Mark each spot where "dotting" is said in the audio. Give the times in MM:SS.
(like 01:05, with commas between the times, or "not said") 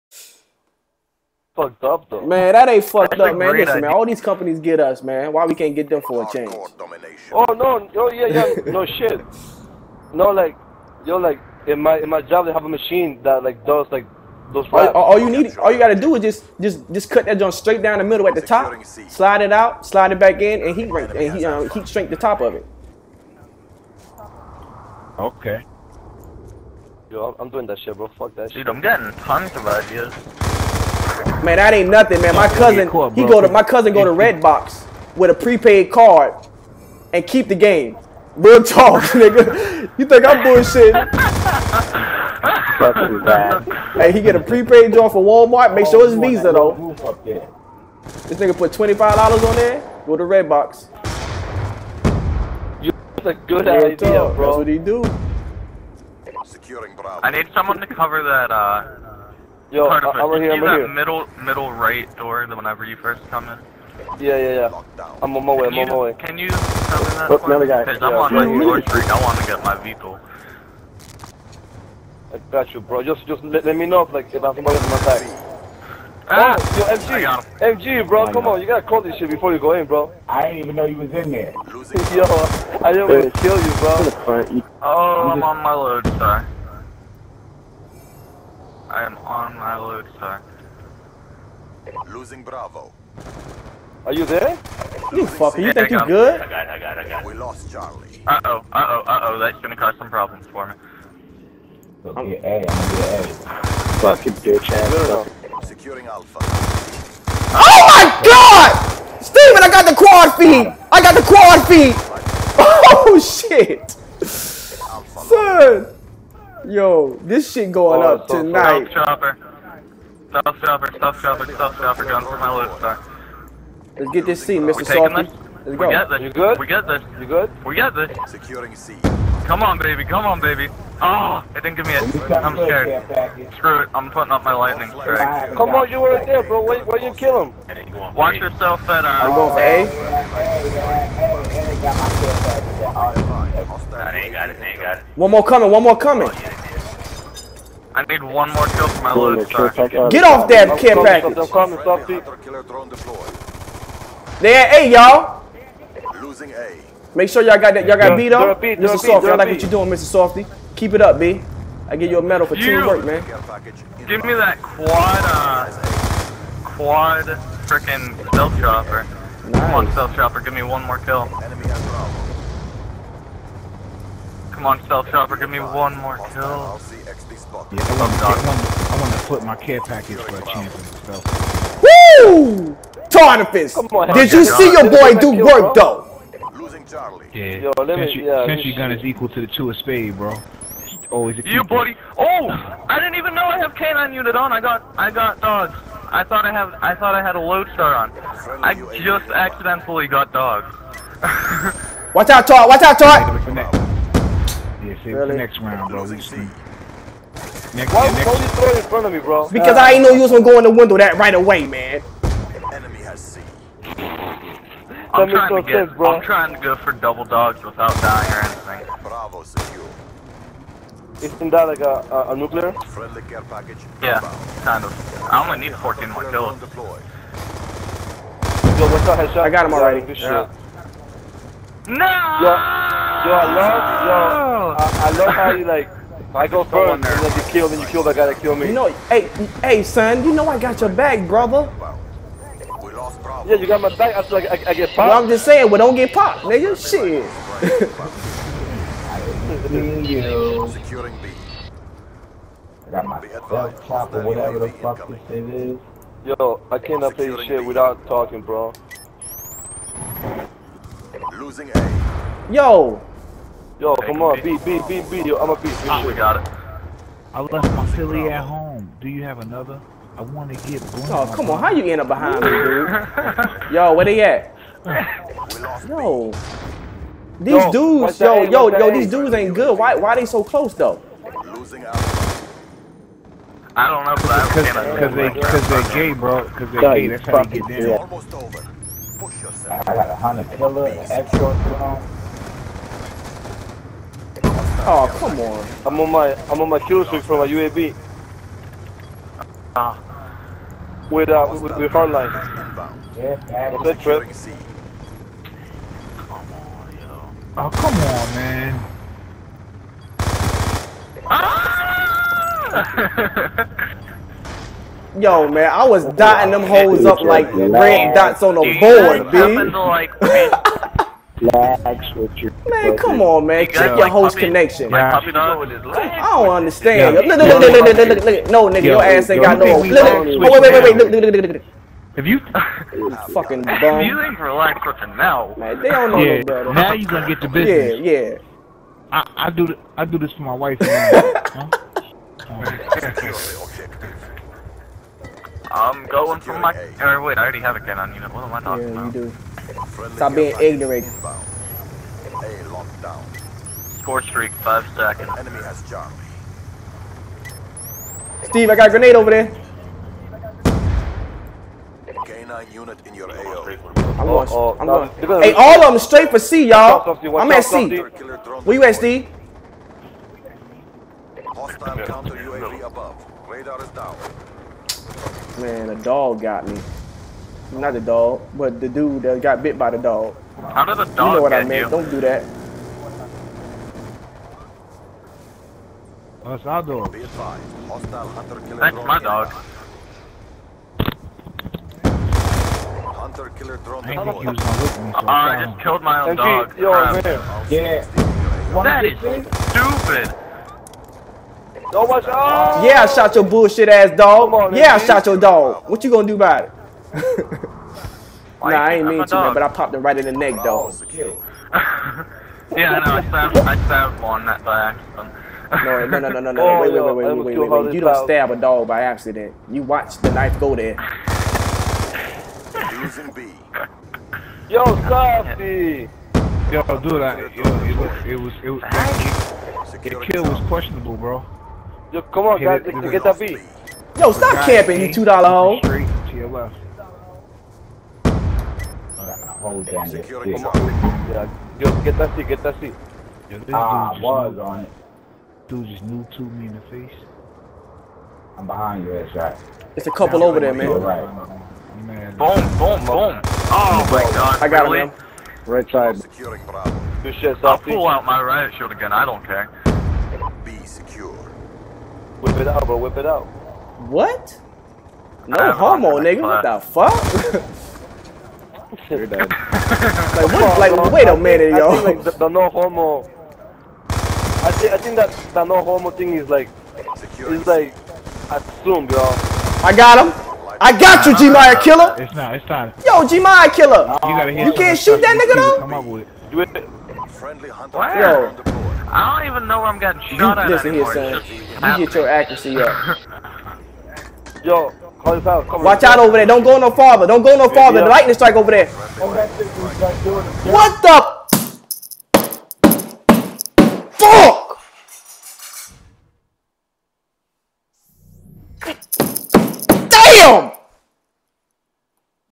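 05:16.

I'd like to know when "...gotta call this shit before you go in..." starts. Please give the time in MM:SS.
01:18.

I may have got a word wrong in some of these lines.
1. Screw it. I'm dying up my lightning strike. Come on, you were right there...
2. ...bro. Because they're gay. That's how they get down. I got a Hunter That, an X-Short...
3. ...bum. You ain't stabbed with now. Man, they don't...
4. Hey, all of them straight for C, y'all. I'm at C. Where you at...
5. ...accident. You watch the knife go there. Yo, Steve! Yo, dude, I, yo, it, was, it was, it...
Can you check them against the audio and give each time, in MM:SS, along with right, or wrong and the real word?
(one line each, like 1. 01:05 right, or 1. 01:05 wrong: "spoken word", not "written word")
1. 02:13 wrong: "putting", not "dying"
2. 04:46 wrong: "Killer", not "That"
3. 05:33 wrong: "relaxed", not "stabbed"
4. 06:05 right
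5. 06:59 wrong: "Softy", not "Steve".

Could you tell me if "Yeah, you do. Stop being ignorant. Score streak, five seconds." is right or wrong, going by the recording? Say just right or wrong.
right.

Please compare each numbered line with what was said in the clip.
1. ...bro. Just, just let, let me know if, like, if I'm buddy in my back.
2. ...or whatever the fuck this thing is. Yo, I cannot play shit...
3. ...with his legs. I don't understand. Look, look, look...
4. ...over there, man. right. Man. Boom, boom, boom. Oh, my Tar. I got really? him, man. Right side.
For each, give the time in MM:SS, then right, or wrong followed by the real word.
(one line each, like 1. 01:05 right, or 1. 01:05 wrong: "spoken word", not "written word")
1. 01:12 wrong: "somebody", not "buddy"
2. 04:14 right
3. 05:25 right
4. 07:30 wrong: "God", not "Tar".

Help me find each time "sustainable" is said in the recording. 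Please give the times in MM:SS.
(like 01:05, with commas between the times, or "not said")
not said.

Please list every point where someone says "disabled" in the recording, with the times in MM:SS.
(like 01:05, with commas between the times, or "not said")
not said.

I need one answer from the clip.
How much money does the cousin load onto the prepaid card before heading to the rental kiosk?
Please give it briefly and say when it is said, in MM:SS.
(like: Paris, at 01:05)
$25, at 00:48.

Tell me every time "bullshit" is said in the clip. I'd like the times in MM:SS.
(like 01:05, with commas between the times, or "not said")
00:40, 06:43.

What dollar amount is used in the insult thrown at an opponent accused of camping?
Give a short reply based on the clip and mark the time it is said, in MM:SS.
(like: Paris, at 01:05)
$2, at 07:15.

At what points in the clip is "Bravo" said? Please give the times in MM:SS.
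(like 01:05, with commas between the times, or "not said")
00:56, 01:32, 03:39.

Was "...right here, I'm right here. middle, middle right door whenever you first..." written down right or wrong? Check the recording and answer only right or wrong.
right.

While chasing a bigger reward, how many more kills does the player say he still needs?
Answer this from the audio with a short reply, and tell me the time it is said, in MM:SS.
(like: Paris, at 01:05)
14, at 03:45.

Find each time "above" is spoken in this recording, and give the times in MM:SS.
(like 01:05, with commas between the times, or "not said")
06:12.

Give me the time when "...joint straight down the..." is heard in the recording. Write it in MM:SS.
00:17.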